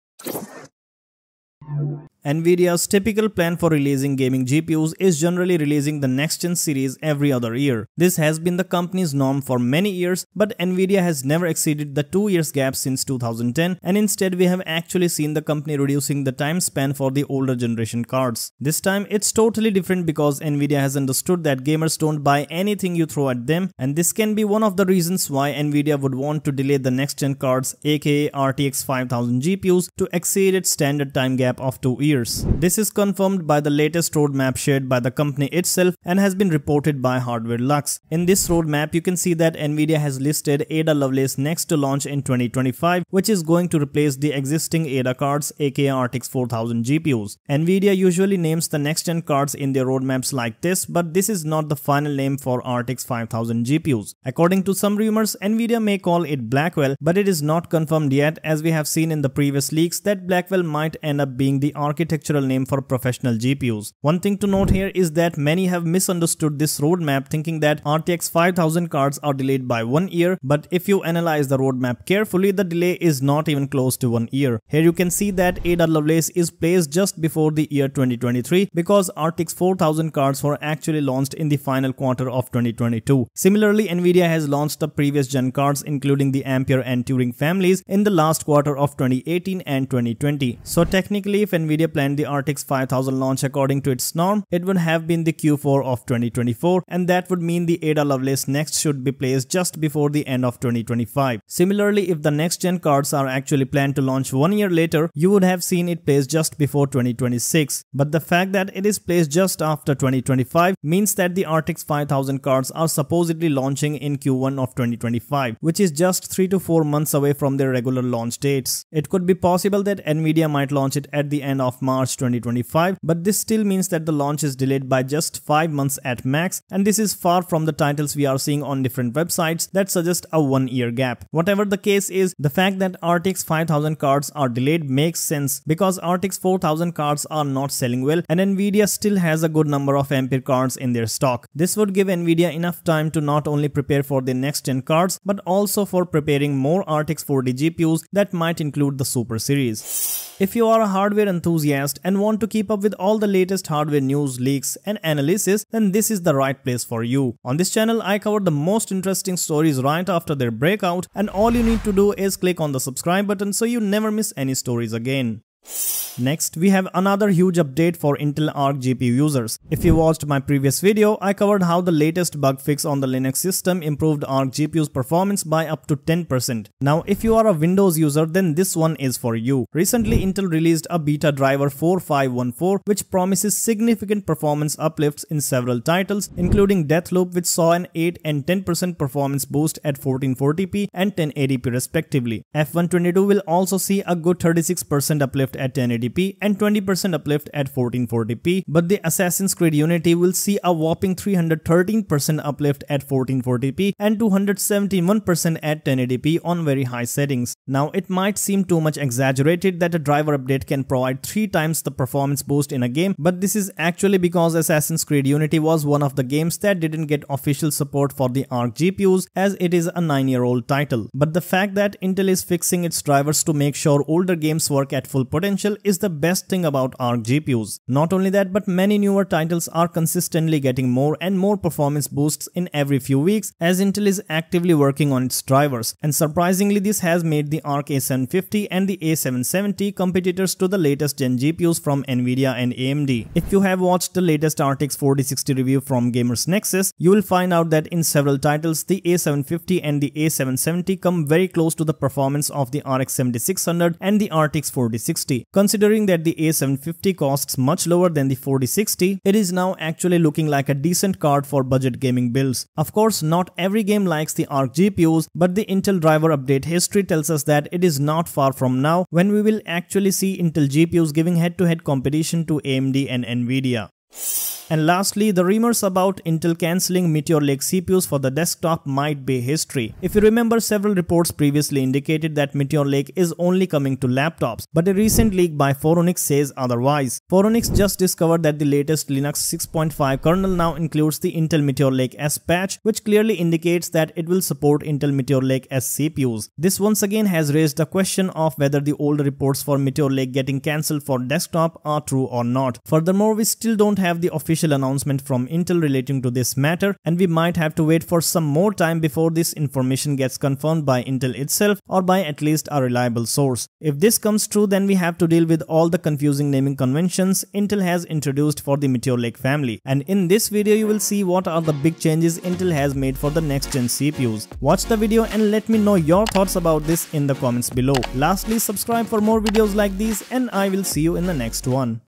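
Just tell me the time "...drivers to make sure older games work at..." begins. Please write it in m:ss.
3:43.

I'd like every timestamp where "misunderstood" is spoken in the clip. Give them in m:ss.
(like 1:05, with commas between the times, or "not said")
1:05.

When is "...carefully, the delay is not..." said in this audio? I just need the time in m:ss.
1:12.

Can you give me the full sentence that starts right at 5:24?
Watch the video and let me know your thoughts about this in the comments below.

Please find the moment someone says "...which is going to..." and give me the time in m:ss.
0:43.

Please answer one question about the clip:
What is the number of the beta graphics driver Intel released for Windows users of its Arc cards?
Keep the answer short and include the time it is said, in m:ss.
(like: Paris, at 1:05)
4514, at 3:01.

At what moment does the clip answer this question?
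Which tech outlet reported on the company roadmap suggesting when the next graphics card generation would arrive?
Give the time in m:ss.
0:37.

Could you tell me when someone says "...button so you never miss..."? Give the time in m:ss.
2:43.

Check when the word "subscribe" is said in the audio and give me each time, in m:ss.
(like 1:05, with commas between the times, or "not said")
2:42, 5:28.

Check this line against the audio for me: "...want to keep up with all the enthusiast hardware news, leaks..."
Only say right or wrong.
wrong.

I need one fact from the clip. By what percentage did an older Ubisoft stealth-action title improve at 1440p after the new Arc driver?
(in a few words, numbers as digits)
313%.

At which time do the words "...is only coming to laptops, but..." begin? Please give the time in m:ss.
4:43.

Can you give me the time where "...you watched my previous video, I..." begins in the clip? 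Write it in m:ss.
2:49.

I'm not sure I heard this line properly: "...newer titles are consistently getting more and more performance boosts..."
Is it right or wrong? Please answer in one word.
right.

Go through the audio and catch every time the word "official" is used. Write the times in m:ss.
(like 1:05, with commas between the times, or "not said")
3:37, 5:04.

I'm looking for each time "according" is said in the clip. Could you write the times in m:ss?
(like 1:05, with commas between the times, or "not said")
0:54, 1:33.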